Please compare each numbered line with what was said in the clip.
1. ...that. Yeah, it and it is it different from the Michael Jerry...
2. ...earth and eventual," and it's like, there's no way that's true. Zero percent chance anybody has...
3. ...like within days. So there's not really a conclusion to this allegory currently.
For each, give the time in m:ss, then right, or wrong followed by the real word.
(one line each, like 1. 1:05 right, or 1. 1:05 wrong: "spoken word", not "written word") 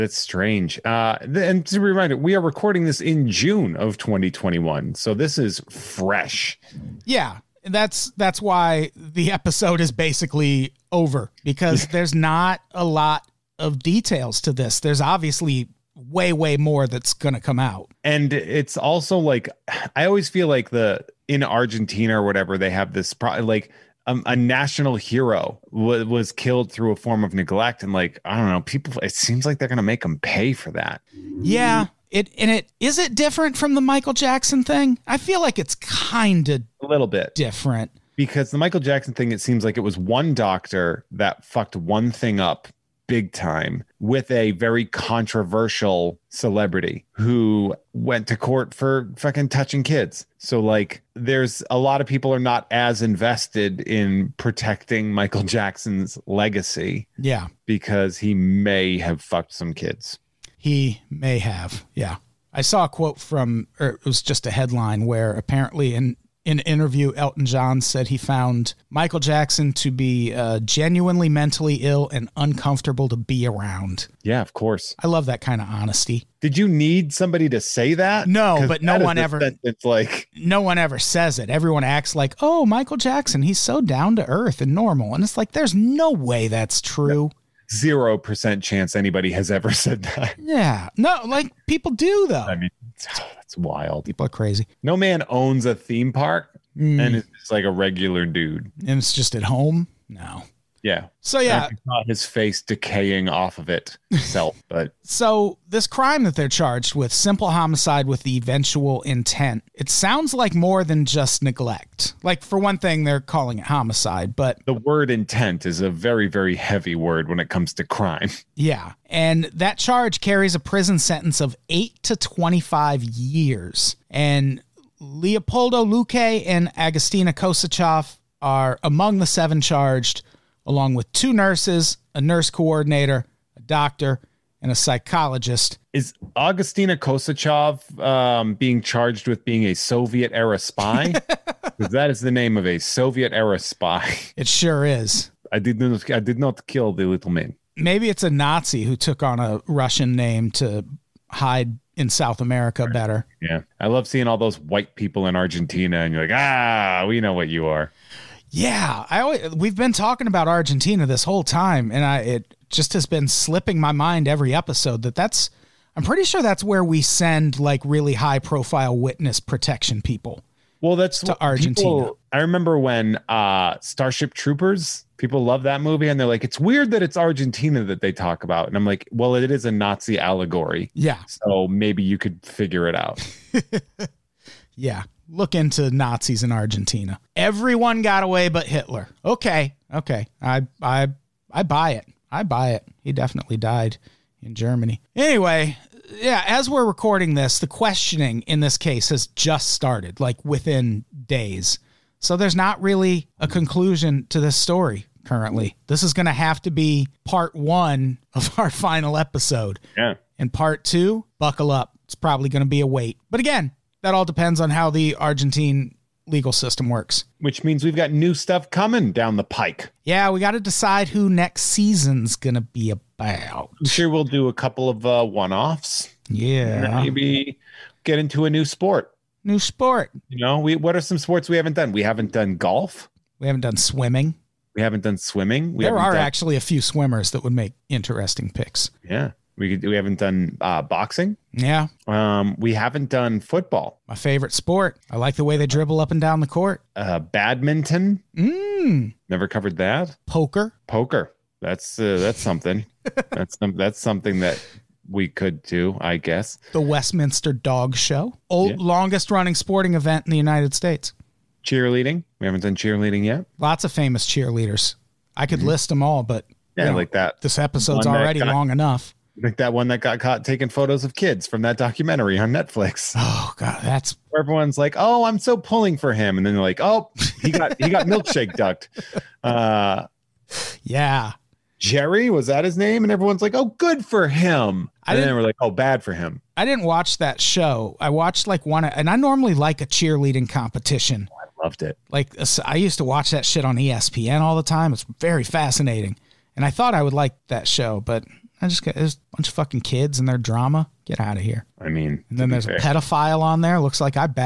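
1. 0:30 wrong: "Jackson", not "Jerry"
2. 1:24 wrong: "normal", not "eventual"
3. 3:20 wrong: "story", not "allegory".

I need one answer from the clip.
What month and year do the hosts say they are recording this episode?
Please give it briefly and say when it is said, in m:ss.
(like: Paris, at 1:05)
June 2021, at 0:03.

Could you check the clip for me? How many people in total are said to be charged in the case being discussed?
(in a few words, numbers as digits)
7.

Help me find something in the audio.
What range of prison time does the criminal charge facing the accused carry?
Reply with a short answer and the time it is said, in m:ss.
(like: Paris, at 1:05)
8 to 25 years, at 2:01.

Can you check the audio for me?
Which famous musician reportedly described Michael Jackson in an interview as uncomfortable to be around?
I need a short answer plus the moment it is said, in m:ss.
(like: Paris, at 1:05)
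Elton John, at 1:07.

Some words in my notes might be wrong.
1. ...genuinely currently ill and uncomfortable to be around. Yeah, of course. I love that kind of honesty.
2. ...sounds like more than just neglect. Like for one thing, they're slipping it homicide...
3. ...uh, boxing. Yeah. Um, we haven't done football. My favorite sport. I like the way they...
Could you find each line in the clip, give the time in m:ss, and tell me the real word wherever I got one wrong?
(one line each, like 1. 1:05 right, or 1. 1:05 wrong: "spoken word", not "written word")
1. 1:10 wrong: "mentally", not "currently"
2. 1:49 wrong: "calling", not "slipping"
3. 4:00 right.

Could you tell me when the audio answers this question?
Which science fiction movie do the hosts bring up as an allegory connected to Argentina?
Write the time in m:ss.
2:53.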